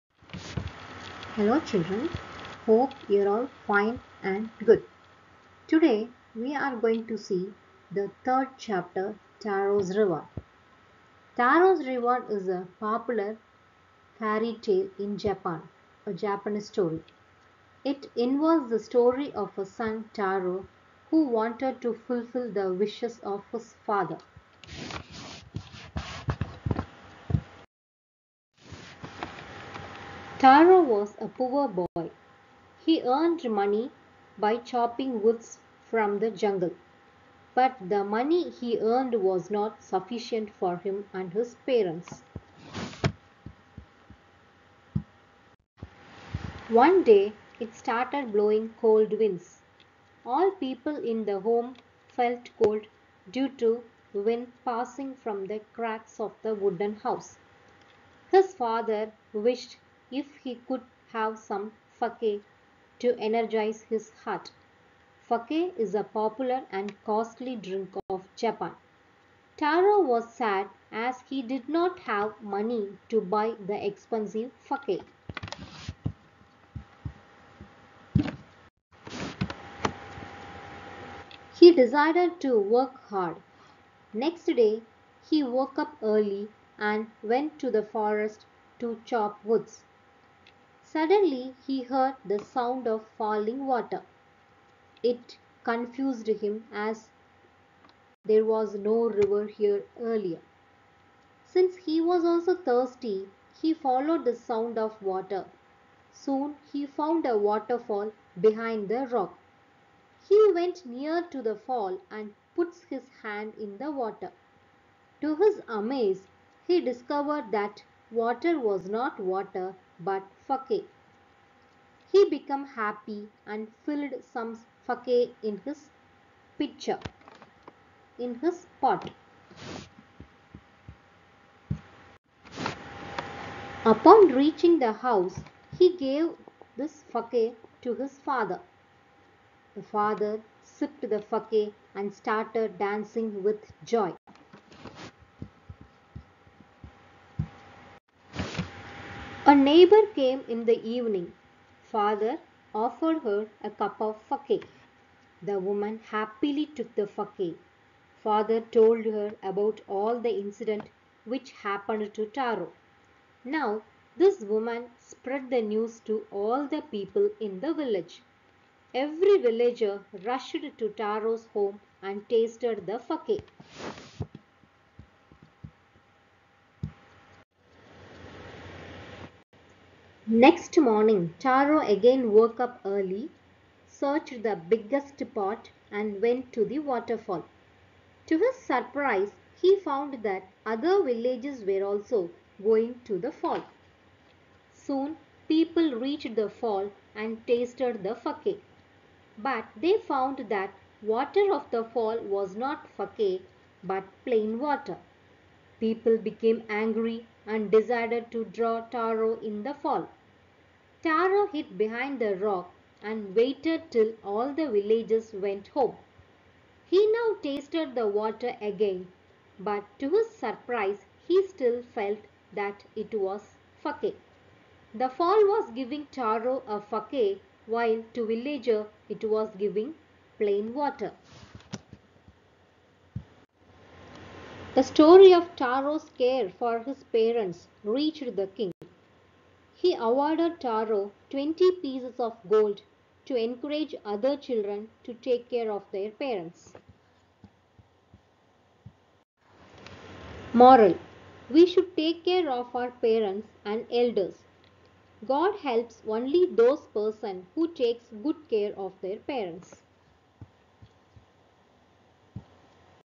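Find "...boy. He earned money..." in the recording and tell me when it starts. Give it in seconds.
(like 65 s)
31 s.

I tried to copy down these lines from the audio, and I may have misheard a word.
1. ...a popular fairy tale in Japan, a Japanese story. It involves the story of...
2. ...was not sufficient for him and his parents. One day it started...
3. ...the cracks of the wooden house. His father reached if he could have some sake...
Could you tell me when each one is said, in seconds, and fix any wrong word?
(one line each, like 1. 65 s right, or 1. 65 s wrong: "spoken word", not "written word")
1. 12 s right
2. 39 s right
3. 55 s wrong: "wished", not "reached".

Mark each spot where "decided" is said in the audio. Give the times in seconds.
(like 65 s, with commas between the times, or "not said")
81 s, 207 s.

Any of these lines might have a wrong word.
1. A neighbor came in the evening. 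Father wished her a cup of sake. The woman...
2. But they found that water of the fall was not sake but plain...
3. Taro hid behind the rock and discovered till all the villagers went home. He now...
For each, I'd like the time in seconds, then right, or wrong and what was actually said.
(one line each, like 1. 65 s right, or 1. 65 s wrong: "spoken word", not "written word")
1. 149 s wrong: "offered", not "wished"
2. 199 s right
3. 211 s wrong: "waited", not "discovered".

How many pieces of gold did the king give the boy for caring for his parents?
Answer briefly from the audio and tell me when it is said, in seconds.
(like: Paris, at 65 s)
20, at 241 s.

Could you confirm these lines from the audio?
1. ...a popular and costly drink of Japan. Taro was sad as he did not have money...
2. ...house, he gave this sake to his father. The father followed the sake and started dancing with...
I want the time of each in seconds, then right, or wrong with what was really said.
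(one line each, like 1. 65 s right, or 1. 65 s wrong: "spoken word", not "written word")
1. 65 s right
2. 135 s wrong: "sipped", not "followed".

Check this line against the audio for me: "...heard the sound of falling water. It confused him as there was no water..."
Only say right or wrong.
wrong.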